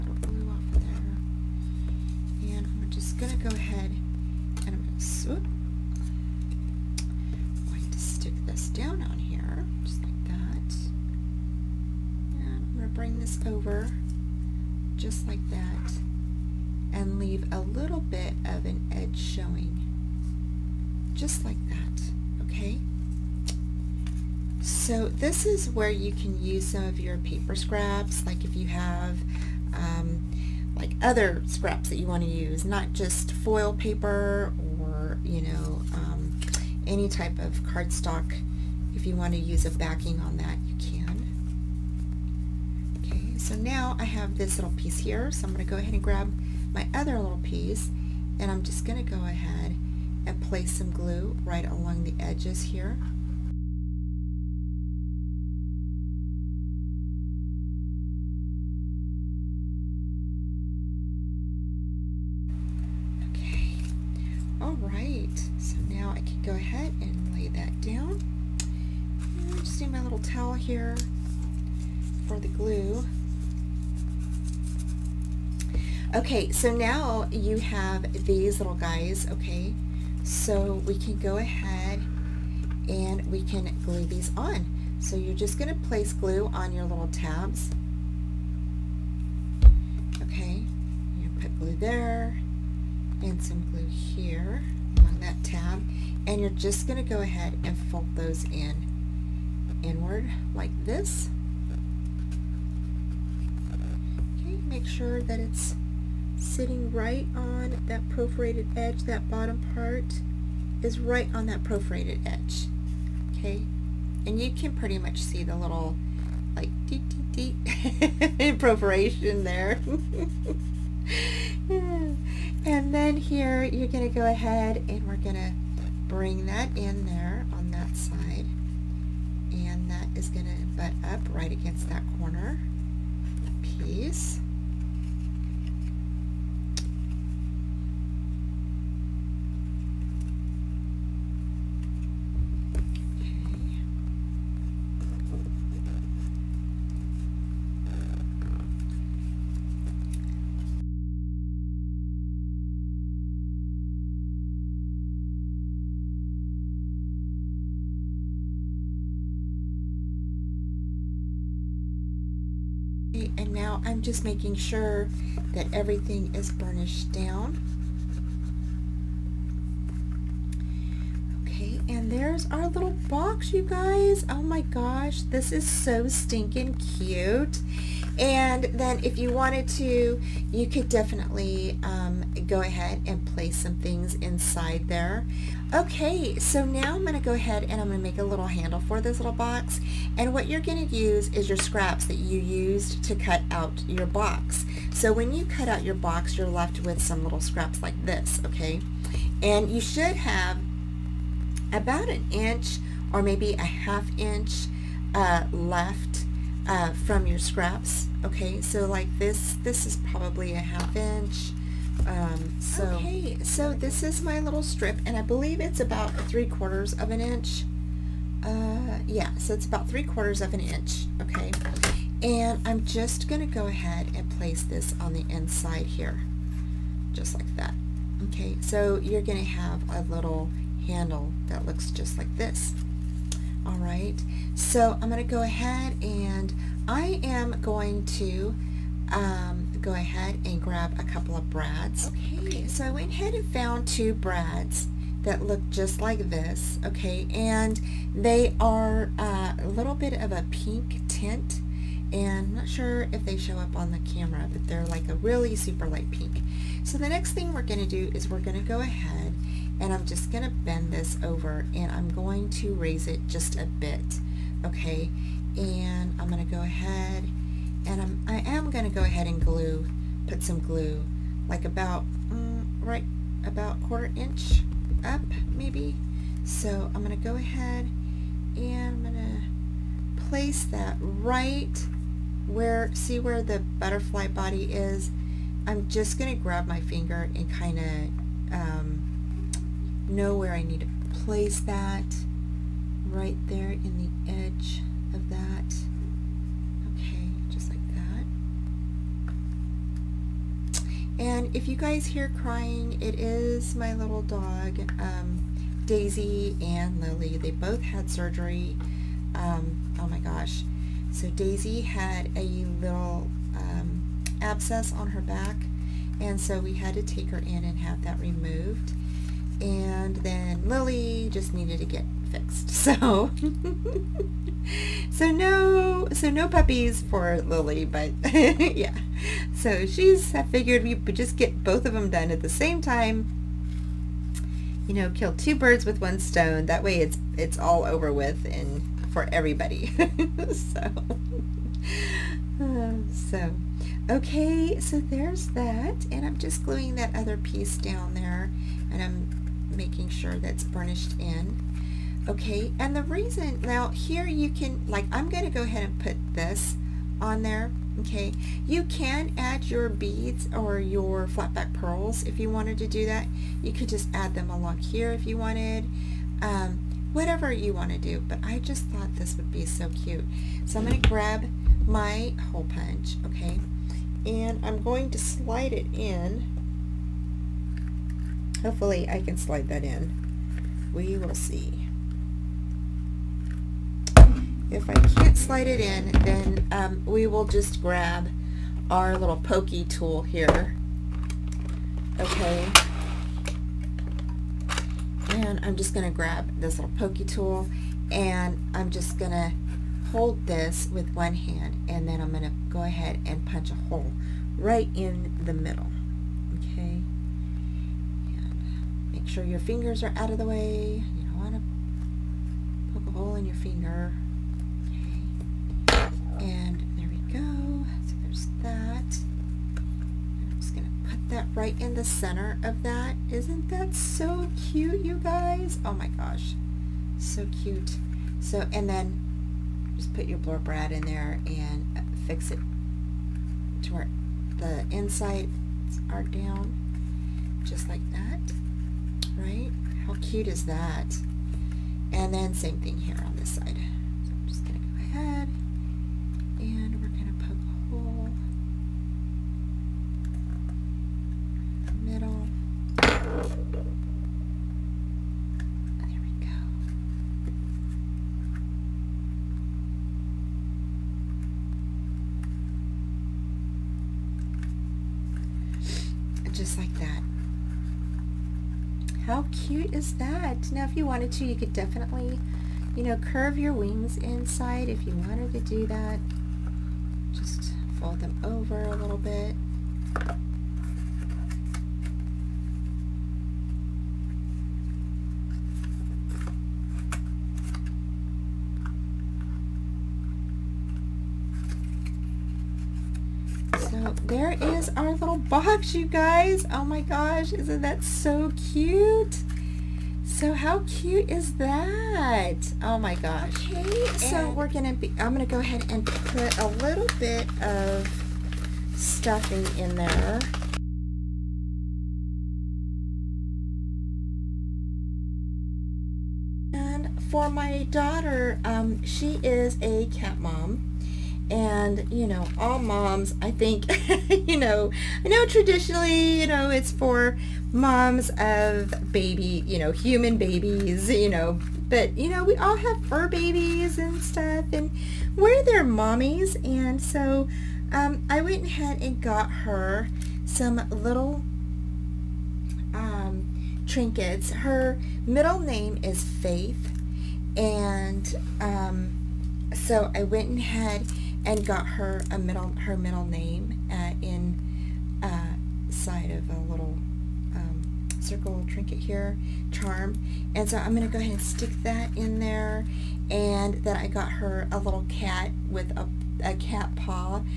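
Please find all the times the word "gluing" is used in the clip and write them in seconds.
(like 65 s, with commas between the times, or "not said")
346 s.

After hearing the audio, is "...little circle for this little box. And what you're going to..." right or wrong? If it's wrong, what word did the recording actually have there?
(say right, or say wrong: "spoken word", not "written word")
wrong: "handle", not "circle".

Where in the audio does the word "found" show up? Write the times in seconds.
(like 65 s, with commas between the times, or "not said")
243 s.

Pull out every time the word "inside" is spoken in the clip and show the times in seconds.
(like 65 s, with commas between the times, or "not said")
184 s, 225 s, 434 s, 474 s.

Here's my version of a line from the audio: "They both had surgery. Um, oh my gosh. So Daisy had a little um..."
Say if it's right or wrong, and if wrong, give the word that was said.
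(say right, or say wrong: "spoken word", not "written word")
right.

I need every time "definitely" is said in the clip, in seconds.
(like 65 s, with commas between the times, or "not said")
180 s, 471 s.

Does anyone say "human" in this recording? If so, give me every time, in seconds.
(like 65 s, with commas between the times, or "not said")
529 s.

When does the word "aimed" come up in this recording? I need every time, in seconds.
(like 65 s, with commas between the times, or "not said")
not said.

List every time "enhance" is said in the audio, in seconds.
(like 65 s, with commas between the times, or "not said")
not said.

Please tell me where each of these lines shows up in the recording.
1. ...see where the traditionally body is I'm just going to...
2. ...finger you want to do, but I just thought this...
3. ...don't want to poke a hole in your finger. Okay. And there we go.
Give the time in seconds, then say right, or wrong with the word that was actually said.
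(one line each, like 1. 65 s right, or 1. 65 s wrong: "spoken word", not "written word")
1. 282 s wrong: "butterfly", not "traditionally"
2. 367 s wrong: "whatever", not "finger"
3. 411 s right.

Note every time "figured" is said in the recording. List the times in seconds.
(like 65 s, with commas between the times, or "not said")
330 s.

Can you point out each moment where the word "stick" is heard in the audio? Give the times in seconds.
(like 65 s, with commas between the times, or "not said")
7 s, 561 s.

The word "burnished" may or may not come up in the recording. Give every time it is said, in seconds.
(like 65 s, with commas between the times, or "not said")
166 s, 350 s.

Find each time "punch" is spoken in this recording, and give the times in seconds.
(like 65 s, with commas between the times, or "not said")
372 s, 403 s.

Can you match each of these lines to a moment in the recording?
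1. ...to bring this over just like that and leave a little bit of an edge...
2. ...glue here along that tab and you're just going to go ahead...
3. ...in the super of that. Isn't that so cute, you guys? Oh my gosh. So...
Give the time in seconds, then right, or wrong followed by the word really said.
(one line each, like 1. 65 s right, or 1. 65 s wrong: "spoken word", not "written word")
1. 12 s right
2. 93 s right
3. 421 s wrong: "center", not "super".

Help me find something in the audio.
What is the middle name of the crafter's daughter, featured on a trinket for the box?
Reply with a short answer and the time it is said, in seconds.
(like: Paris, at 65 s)
Faith, at 546 s.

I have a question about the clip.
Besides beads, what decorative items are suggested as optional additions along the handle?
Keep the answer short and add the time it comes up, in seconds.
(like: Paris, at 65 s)
flat back pearls, at 361 s.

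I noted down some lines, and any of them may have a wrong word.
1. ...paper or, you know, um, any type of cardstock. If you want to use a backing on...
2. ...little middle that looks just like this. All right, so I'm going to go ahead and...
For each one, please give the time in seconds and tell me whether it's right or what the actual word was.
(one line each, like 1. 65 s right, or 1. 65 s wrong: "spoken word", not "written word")
1. 33 s right
2. 230 s wrong: "handle", not "middle".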